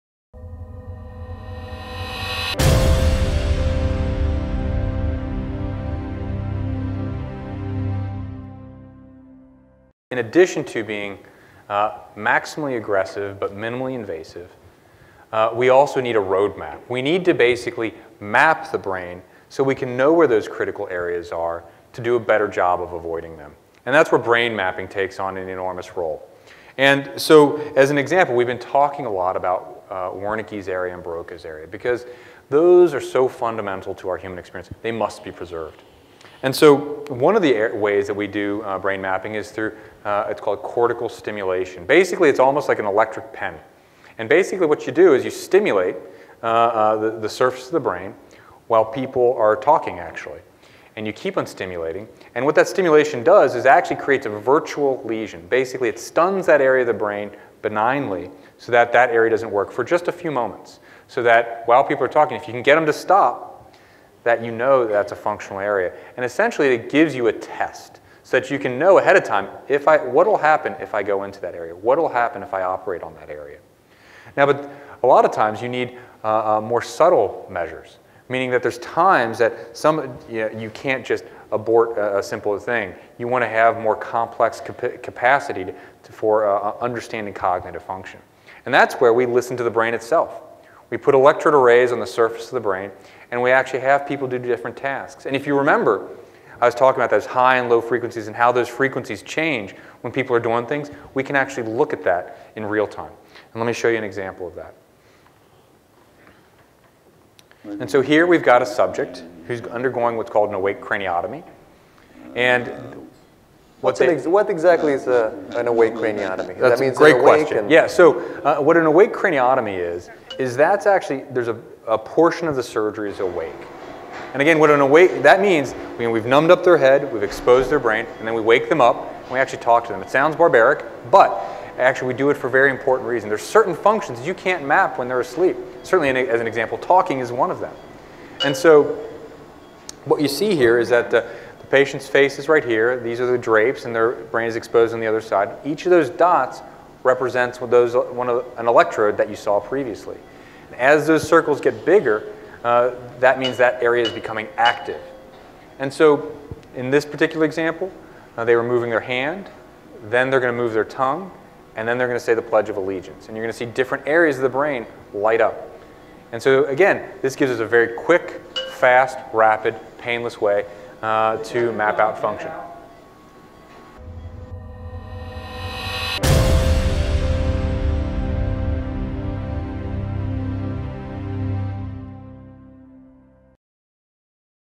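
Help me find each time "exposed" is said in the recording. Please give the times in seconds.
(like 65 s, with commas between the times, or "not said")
127 s, 144 s.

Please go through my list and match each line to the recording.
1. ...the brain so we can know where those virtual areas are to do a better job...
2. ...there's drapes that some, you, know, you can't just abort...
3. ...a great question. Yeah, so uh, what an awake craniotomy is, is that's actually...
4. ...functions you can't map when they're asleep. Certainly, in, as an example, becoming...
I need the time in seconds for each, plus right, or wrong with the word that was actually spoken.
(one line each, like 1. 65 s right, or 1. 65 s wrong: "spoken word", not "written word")
1. 18 s wrong: "critical", not "virtual"
2. 78 s wrong: "times", not "drapes"
3. 116 s right
4. 133 s wrong: "talking", not "becoming".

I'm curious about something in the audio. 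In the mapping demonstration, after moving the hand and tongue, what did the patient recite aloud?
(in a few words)
the Pledge of Allegiance.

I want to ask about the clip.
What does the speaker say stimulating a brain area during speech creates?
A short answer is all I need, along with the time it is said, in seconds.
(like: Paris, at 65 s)
a virtual lesion, at 54 s.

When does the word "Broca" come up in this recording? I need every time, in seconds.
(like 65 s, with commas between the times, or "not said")
31 s.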